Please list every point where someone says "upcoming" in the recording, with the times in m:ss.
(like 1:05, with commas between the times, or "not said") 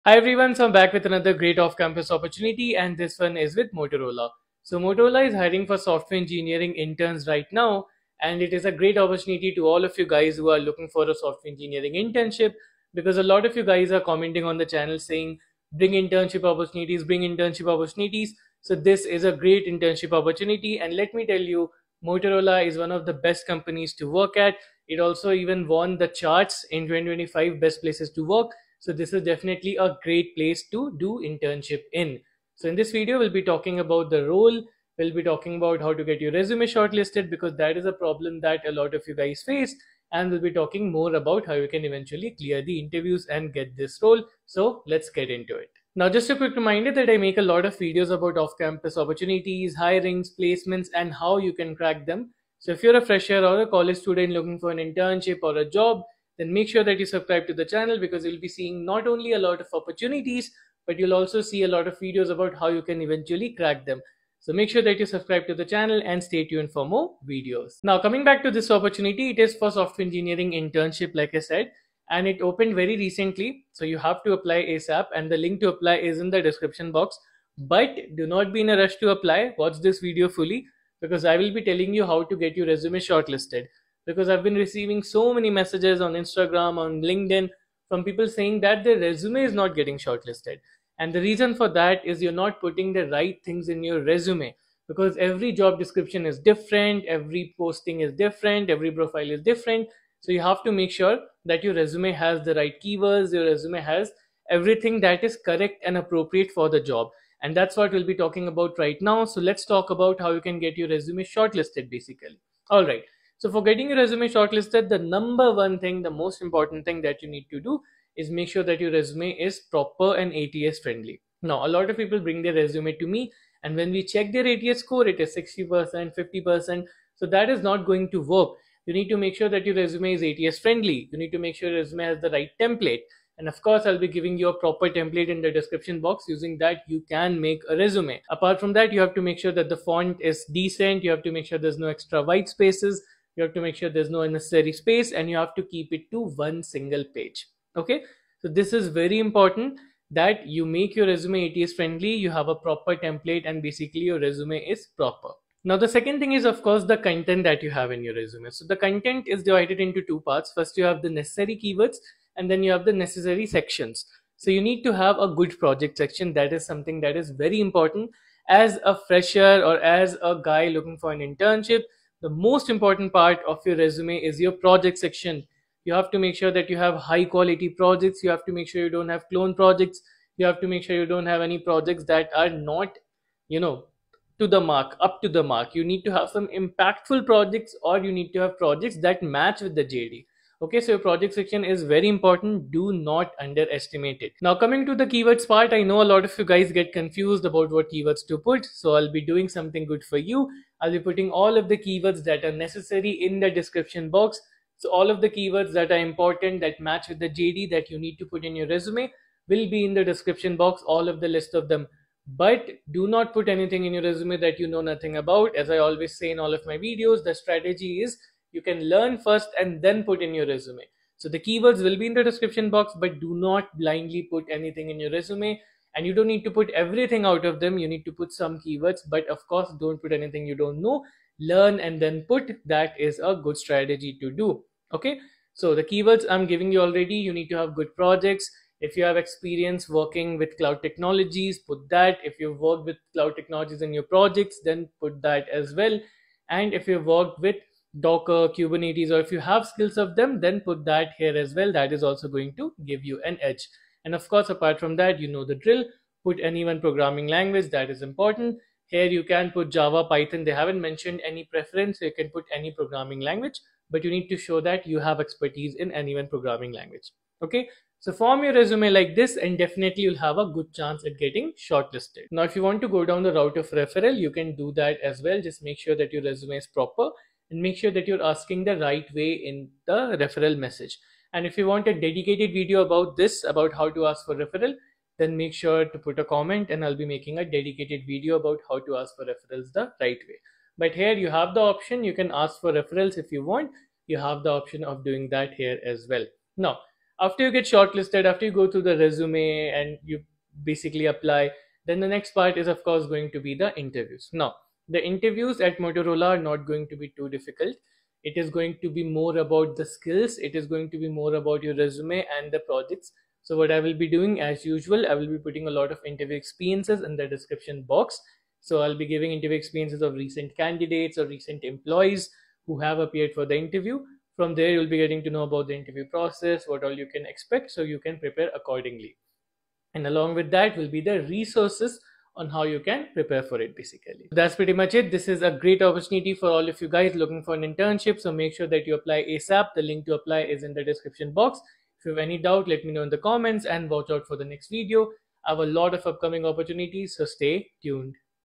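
5:46.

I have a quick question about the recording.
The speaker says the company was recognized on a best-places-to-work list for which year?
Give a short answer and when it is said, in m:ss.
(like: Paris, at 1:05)
2025, at 0:26.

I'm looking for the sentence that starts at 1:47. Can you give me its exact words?
And that's what we'll be talking about right now.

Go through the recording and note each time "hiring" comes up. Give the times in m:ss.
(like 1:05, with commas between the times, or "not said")
0:05, 0:49.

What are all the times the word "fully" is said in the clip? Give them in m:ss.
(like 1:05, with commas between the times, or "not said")
1:20.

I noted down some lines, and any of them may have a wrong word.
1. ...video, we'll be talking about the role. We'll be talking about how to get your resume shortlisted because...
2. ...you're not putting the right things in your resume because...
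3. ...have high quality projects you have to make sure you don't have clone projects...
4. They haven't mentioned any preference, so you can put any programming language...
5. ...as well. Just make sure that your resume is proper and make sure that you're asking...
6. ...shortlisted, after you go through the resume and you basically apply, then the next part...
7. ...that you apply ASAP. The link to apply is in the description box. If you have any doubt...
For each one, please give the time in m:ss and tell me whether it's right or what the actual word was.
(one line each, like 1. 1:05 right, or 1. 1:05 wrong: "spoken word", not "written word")
1. 0:32 right
2. 1:32 right
3. 2:56 right
4. 4:20 right
5. 4:35 right
6. 4:57 right
7. 5:38 right.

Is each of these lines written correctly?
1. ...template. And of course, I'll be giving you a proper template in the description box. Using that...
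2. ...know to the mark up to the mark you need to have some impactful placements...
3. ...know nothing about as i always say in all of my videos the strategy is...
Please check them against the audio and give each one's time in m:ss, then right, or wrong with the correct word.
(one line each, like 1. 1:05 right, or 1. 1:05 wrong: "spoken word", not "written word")
1. 2:12 right
2. 3:03 wrong: "projects", not "placements"
3. 3:34 right.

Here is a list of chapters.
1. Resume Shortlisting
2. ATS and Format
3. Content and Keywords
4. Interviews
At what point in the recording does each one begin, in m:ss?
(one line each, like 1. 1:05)
1. 1:08
2. 1:53
3. 2:35
4. 5:00.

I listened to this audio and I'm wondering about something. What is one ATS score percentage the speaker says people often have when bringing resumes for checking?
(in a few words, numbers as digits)
60%.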